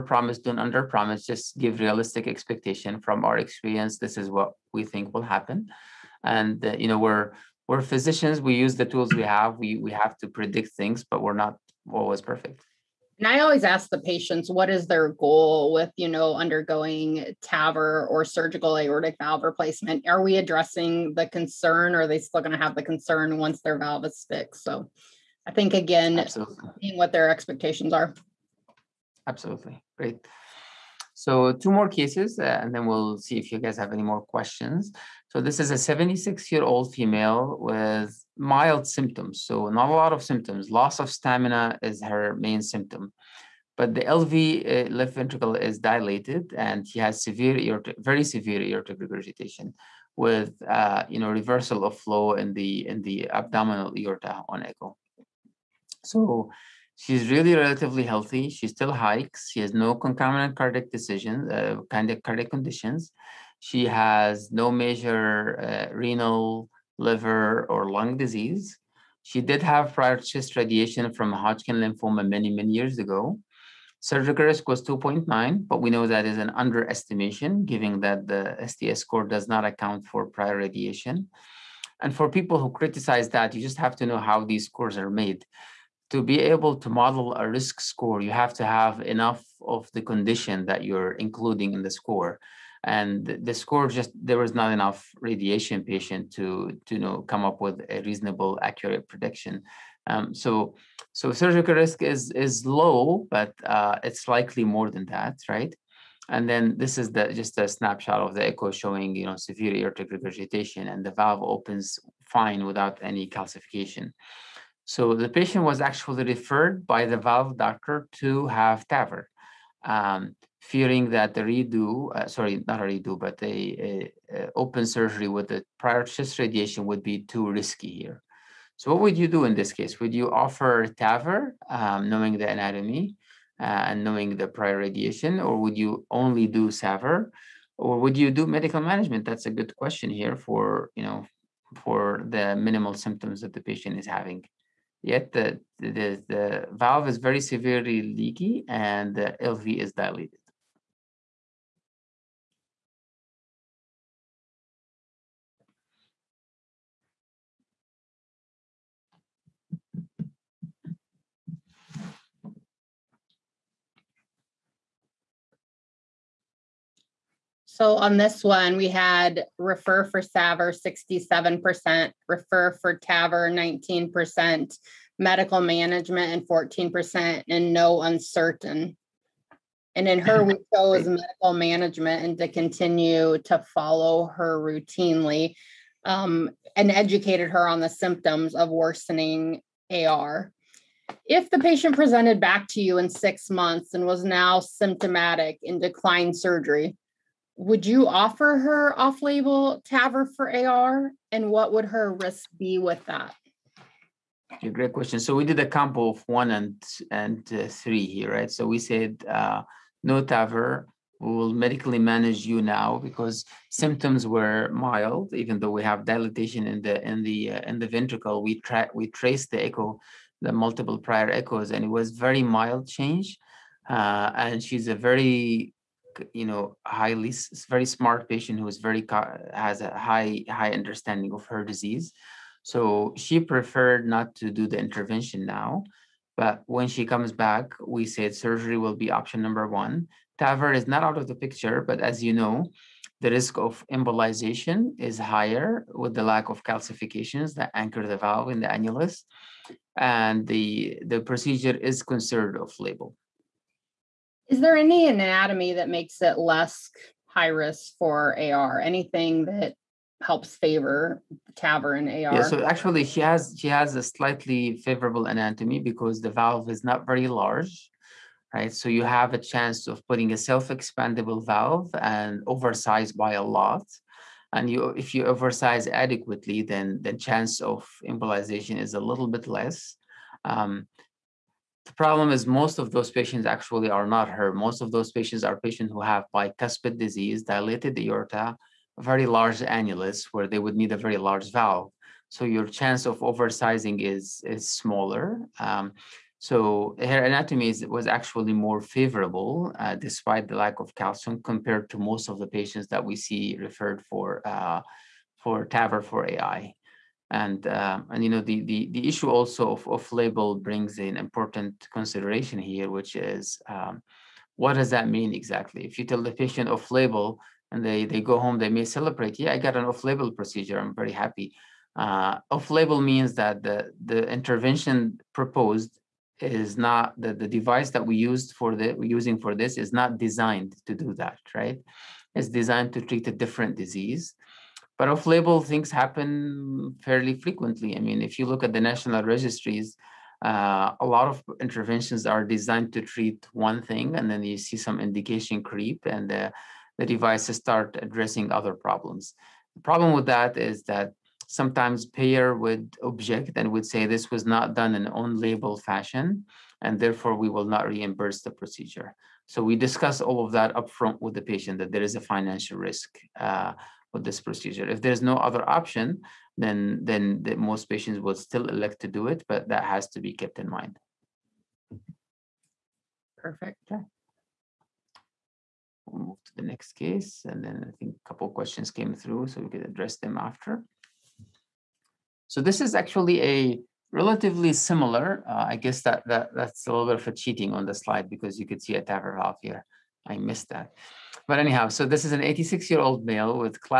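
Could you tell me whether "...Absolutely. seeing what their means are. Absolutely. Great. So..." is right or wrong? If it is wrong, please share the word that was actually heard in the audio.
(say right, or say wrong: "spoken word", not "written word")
wrong: "expectations", not "means".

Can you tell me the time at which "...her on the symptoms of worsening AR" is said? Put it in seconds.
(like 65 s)
187 s.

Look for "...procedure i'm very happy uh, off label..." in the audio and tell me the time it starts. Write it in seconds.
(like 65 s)
320 s.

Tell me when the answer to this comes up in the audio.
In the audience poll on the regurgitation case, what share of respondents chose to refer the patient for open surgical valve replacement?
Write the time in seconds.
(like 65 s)
170 s.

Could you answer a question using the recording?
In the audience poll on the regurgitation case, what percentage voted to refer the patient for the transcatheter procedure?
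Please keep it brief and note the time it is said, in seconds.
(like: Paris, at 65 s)
19%, at 173 s.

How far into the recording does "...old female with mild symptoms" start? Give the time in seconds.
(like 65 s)
36 s.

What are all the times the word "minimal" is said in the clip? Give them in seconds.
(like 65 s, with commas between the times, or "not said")
142 s.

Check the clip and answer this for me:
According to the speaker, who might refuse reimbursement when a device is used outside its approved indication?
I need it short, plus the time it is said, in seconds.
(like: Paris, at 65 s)
payer, at 352 s.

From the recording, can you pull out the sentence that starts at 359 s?
So we discuss all of that upfront with the patient that there is a financial risk uh, with this procedure.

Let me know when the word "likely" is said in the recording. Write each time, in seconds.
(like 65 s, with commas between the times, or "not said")
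104 s.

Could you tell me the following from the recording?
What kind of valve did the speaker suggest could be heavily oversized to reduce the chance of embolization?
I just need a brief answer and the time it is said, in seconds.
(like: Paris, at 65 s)
self-expandable, at 270 s.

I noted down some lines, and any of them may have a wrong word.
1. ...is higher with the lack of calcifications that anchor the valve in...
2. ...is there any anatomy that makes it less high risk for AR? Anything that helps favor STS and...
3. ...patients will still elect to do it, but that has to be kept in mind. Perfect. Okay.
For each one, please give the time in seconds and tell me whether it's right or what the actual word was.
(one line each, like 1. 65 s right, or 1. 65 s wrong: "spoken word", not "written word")
1. 244 s right
2. 254 s wrong: "TAVR", not "STS"
3. 367 s right.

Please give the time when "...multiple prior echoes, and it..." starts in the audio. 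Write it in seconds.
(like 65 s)
220 s.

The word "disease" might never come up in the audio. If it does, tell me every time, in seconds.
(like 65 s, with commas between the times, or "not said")
68 s, 231 s, 286 s, 333 s.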